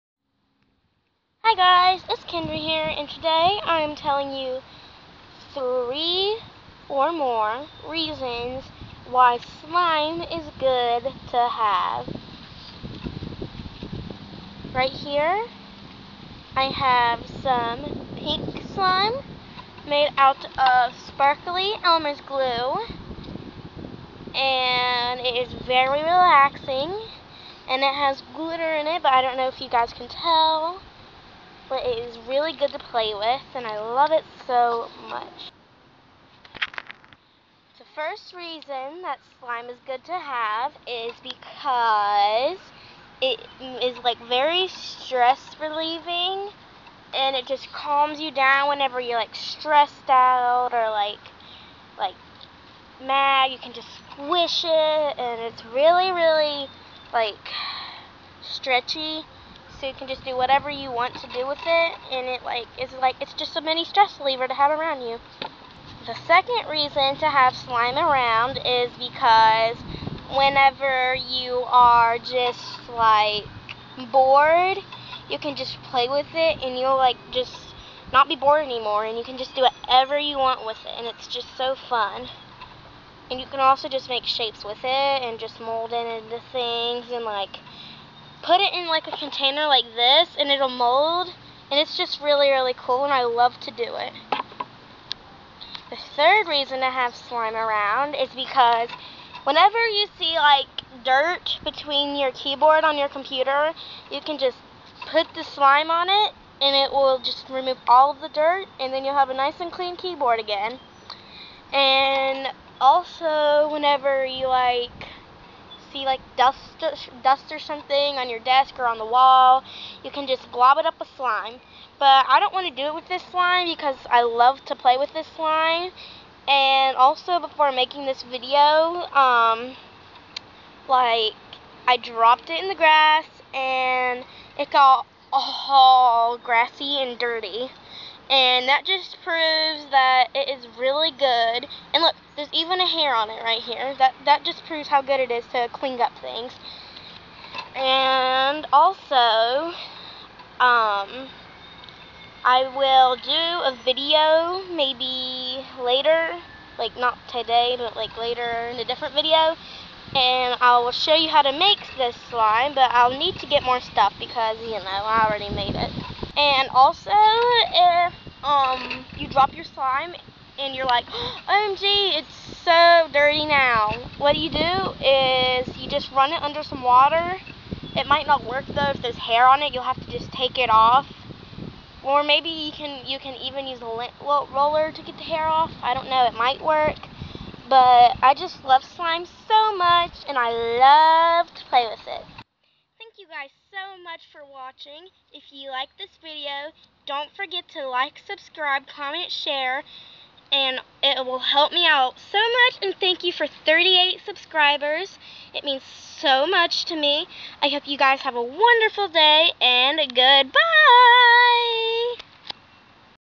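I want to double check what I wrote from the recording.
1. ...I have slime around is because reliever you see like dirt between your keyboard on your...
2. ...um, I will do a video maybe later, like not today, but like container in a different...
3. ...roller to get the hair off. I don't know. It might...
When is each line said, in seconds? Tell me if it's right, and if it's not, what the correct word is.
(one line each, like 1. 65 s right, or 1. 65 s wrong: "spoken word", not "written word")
1. 96 s wrong: "whenever", not "reliever"
2. 150 s wrong: "later", not "container"
3. 184 s right.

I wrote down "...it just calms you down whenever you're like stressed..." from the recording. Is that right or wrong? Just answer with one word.
right.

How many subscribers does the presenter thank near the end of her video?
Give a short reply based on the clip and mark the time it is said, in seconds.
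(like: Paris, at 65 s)
38, at 203 s.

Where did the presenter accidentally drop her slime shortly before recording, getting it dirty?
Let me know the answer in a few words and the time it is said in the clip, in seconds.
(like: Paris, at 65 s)
In the grass, at 132 s.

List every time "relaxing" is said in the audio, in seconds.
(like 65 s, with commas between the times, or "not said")
26 s.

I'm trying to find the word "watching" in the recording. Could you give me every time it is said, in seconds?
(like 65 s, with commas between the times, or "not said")
194 s.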